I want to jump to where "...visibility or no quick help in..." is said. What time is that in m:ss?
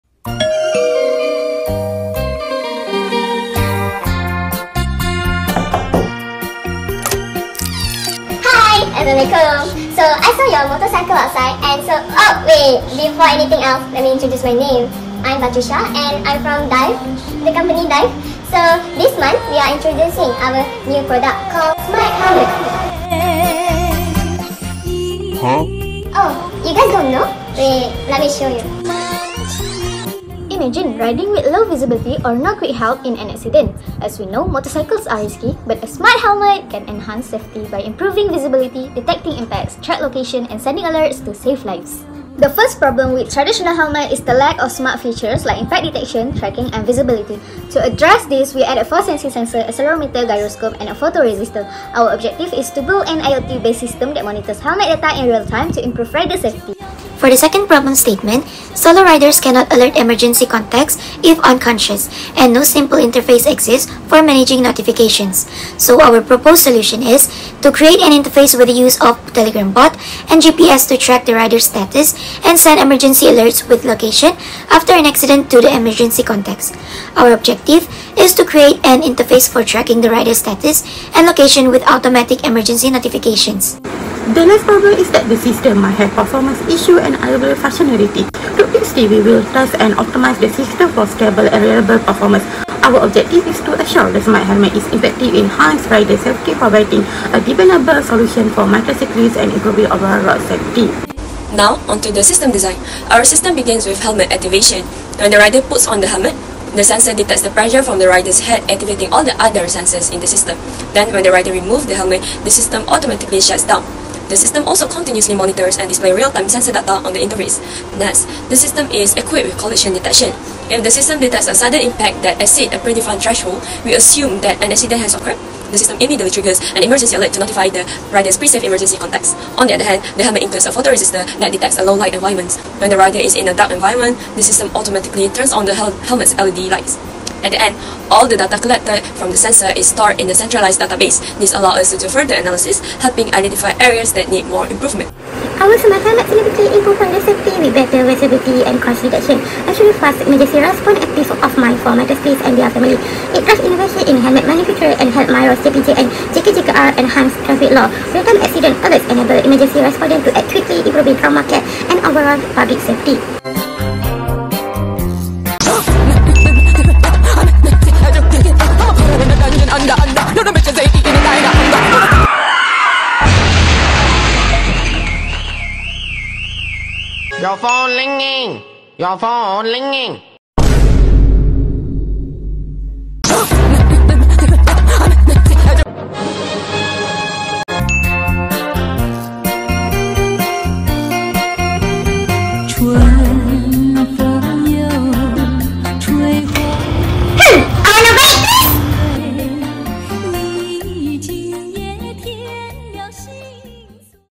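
0:31.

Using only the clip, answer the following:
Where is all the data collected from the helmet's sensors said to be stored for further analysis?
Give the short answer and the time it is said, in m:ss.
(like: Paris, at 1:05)
Centralized database, at 2:20.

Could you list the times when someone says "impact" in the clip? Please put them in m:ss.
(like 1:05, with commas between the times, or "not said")
0:39, 0:45, 2:01.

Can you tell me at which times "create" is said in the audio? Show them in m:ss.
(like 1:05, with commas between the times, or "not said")
1:07, 1:18.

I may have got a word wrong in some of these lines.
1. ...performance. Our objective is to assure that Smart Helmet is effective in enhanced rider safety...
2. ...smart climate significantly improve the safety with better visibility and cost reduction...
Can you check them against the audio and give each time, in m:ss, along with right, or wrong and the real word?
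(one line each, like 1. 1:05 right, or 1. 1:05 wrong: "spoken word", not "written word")
1. 1:31 right
2. 2:25 right.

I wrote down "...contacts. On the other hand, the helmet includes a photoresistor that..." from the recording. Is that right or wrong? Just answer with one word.
right.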